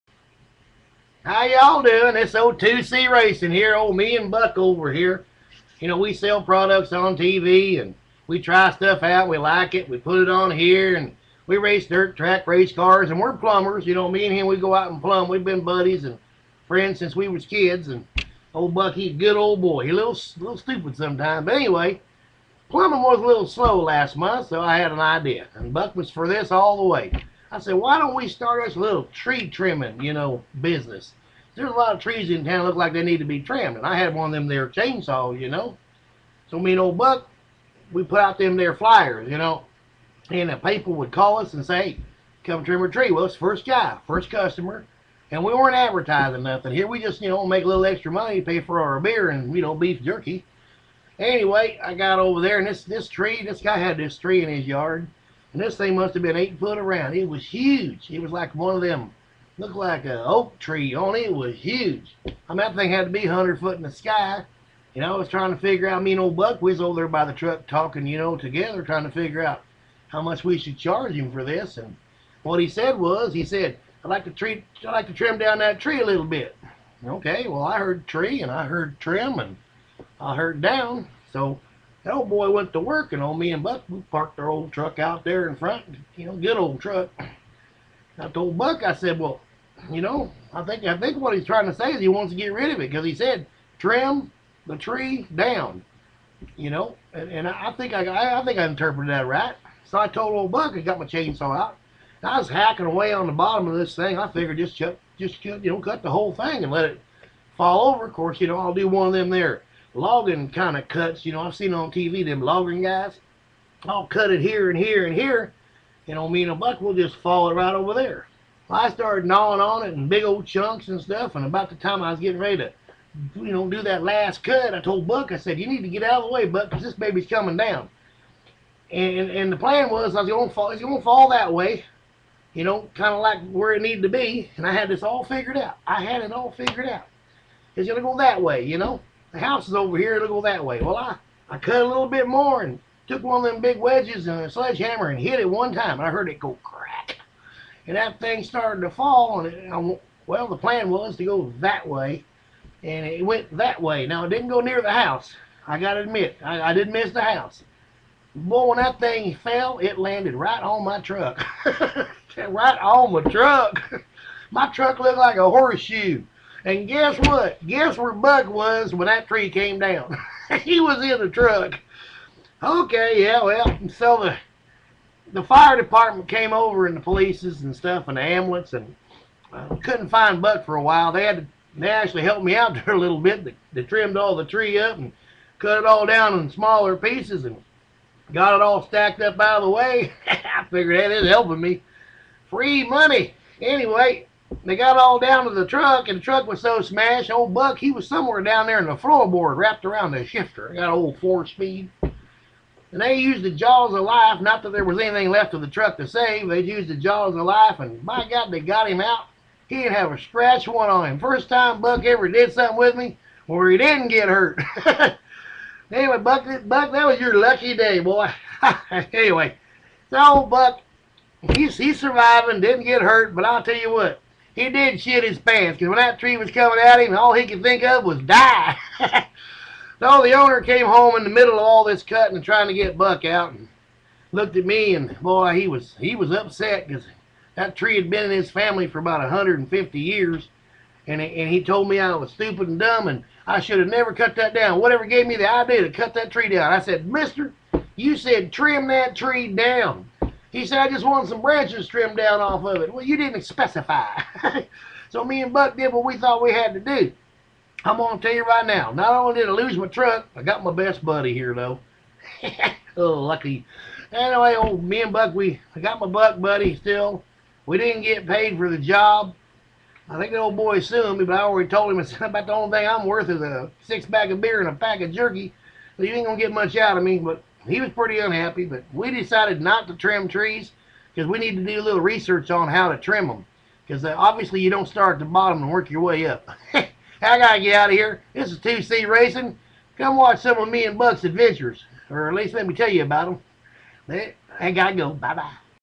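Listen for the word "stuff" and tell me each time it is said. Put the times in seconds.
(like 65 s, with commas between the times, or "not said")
8 s, 121 s, 177 s.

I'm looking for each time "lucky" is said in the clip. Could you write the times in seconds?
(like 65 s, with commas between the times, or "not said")
217 s, 263 s.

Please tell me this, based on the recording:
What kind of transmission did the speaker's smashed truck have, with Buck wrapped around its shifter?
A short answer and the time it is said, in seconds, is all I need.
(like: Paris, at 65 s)
Four speed, at 201 s.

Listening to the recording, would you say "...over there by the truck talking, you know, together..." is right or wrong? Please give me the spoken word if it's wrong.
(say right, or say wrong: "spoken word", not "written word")
right.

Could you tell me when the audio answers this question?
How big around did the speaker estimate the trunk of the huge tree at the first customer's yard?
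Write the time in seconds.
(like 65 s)
56 s.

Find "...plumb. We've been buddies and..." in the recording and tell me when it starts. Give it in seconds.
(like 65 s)
14 s.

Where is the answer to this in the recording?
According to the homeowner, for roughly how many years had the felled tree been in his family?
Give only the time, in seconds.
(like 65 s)
239 s.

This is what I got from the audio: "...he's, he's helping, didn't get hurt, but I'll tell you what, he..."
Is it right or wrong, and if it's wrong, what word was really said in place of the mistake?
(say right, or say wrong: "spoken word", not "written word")
wrong: "surviving", not "helping".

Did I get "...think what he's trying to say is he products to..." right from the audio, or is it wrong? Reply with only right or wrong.
wrong.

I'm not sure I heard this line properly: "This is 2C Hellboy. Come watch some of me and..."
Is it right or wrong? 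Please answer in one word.
wrong.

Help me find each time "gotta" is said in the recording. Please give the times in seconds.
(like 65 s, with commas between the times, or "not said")
287 s, 294 s.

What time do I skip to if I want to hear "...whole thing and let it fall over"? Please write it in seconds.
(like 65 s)
106 s.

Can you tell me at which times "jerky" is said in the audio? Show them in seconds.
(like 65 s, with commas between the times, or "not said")
50 s, 275 s.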